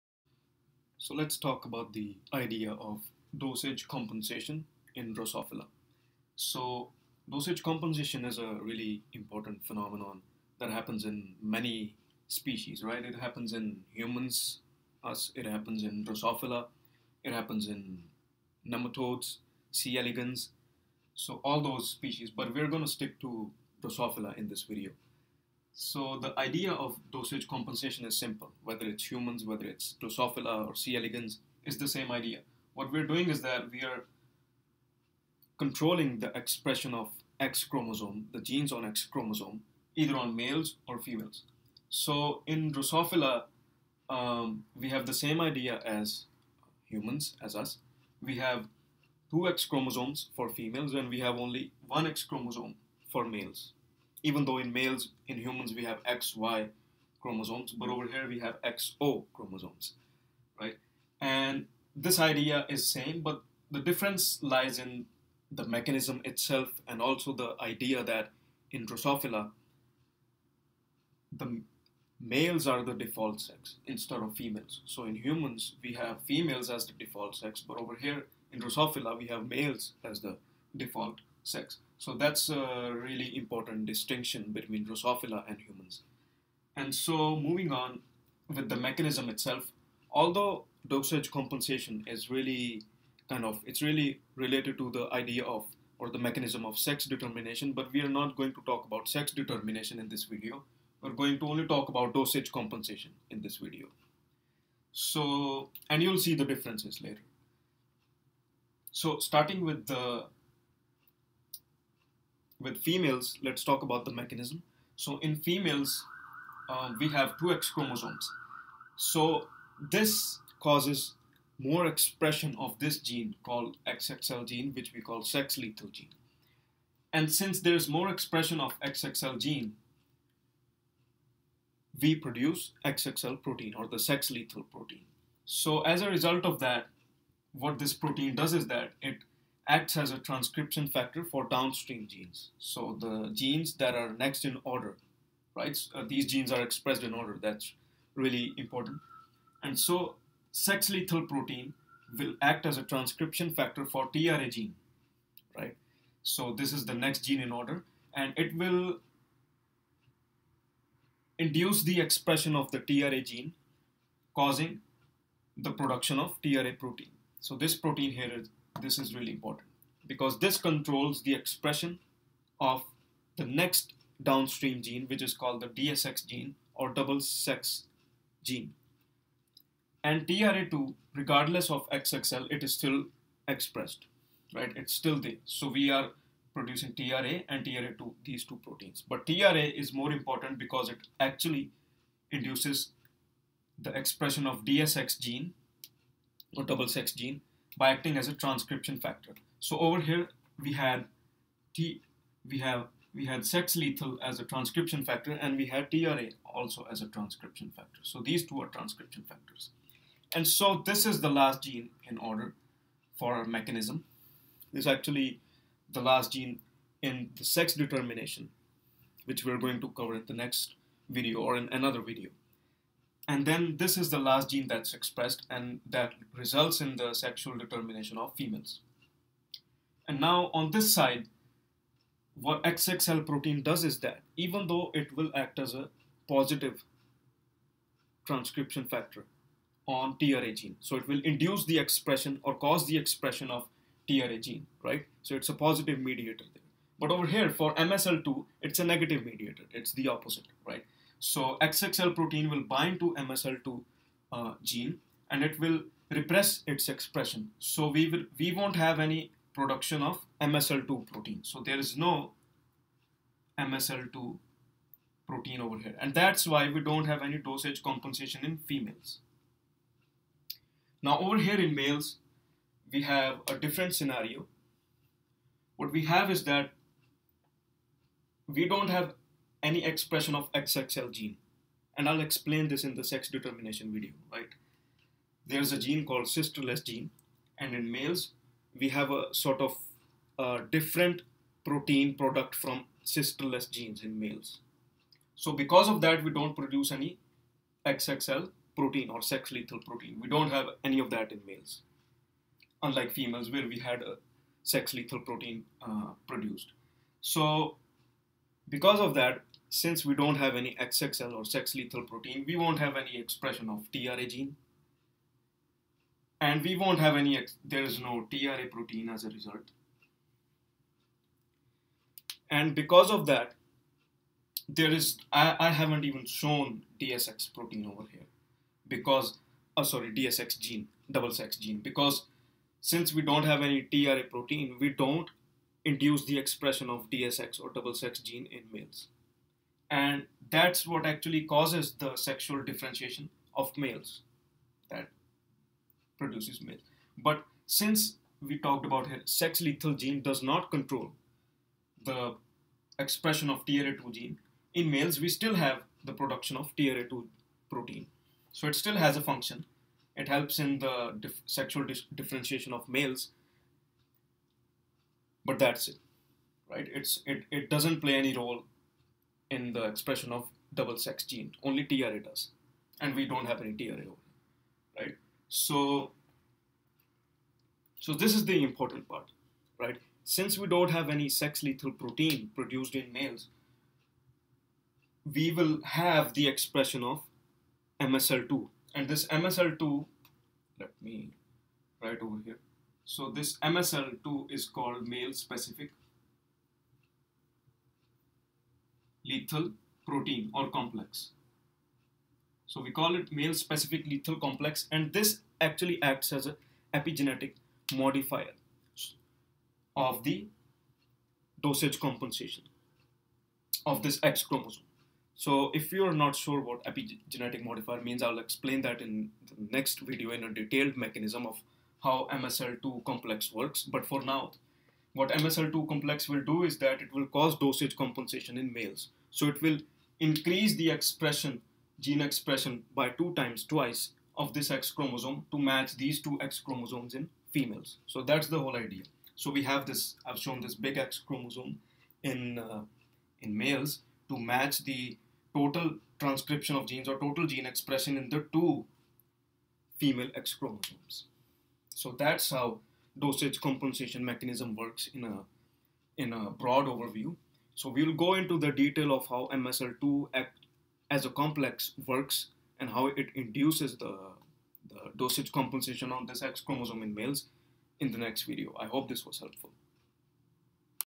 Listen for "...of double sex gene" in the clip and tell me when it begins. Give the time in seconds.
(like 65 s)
370 s.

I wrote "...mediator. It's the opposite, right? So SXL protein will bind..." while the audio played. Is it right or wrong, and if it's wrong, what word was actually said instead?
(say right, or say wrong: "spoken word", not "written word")
right.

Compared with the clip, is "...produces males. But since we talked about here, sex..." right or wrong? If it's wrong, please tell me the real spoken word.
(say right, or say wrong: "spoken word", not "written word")
right.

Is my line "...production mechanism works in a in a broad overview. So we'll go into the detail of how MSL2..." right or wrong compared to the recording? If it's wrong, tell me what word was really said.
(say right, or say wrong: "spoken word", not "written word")
wrong: "compensation", not "production".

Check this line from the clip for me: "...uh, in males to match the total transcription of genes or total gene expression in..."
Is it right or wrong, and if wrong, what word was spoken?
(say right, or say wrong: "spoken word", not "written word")
right.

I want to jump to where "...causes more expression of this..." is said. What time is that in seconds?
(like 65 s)
120 s.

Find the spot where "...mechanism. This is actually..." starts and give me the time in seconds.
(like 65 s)
213 s.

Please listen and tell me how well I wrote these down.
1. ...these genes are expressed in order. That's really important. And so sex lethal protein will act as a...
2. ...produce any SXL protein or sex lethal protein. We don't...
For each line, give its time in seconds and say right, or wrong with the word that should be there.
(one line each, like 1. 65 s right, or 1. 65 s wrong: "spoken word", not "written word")
1. 146 s right
2. 296 s right.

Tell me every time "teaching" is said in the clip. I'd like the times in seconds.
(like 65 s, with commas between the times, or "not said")
not said.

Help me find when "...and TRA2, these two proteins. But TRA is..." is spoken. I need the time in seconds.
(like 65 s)
187 s.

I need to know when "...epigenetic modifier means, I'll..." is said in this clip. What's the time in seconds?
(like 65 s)
416 s.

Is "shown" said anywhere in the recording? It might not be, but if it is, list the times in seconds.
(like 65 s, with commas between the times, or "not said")
326 s, 440 s.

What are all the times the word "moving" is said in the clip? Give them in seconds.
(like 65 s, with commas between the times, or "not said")
87 s.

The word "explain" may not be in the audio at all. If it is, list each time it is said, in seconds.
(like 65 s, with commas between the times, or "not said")
282 s, 418 s.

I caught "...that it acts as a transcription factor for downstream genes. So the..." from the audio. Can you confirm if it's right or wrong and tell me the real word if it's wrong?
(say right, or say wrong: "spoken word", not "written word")
right.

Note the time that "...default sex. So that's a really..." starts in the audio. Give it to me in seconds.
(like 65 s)
80 s.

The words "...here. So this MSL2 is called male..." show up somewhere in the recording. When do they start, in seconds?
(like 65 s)
392 s.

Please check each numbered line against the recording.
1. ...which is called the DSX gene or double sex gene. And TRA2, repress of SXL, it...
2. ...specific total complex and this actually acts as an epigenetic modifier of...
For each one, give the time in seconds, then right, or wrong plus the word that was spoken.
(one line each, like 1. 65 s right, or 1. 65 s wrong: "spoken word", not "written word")
1. 175 s wrong: "regardless", not "repress"
2. 403 s wrong: "lethal", not "total".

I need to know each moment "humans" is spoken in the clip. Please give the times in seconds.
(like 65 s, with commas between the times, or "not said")
13 s, 29 s, 46 s, 55 s, 75 s, 85 s.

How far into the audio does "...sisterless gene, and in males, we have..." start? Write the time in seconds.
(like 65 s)
286 s.